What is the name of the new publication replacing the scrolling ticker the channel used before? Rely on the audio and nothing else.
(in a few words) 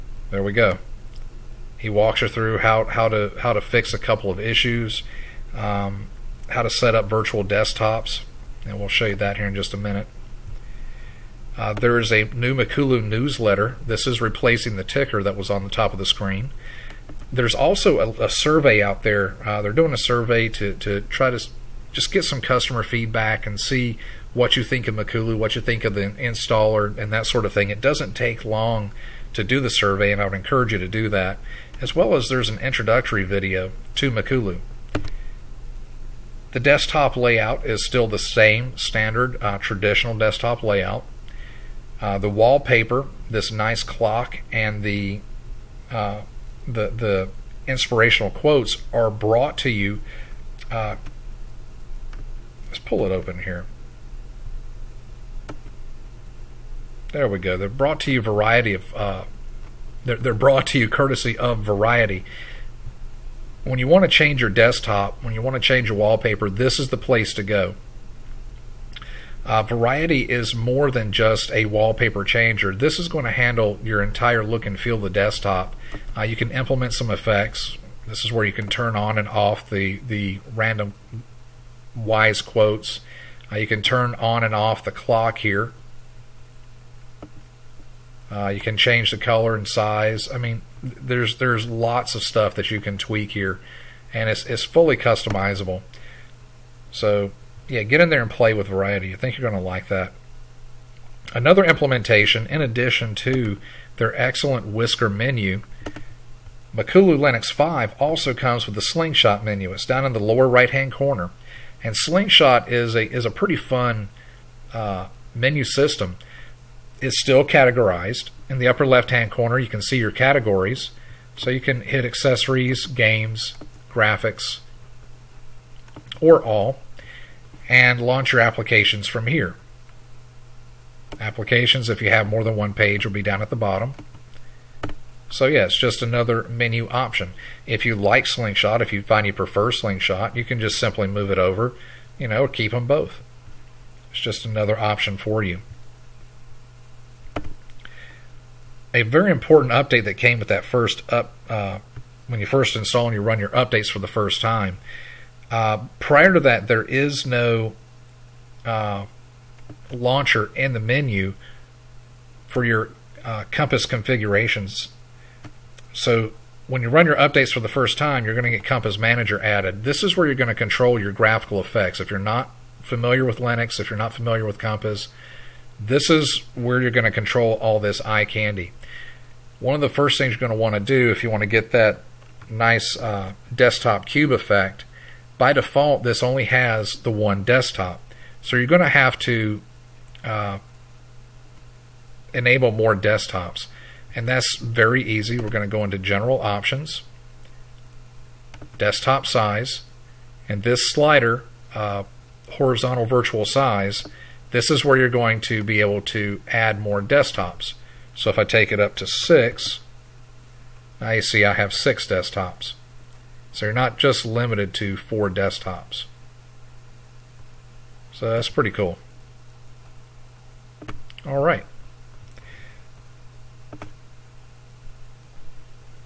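Makulu newsletter.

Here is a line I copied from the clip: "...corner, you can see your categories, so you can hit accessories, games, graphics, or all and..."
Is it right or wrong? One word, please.
right.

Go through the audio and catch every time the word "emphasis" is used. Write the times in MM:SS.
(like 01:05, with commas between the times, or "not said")
not said.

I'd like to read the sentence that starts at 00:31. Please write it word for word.
As well as there's an introductory video to Makulu.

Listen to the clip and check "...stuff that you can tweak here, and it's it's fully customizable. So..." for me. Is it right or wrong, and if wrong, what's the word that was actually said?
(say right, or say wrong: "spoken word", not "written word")
right.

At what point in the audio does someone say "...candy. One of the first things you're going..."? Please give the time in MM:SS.
02:58.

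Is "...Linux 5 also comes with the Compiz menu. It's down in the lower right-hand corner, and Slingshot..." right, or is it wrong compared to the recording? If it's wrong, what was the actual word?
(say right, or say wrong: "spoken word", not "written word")
wrong: "Slingshot", not "Compiz".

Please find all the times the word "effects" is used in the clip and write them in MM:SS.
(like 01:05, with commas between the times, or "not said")
01:17, 02:51, 03:04.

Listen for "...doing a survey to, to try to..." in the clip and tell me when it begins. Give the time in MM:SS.
00:19.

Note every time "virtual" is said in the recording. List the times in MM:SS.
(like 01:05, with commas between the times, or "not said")
00:07, 03:23.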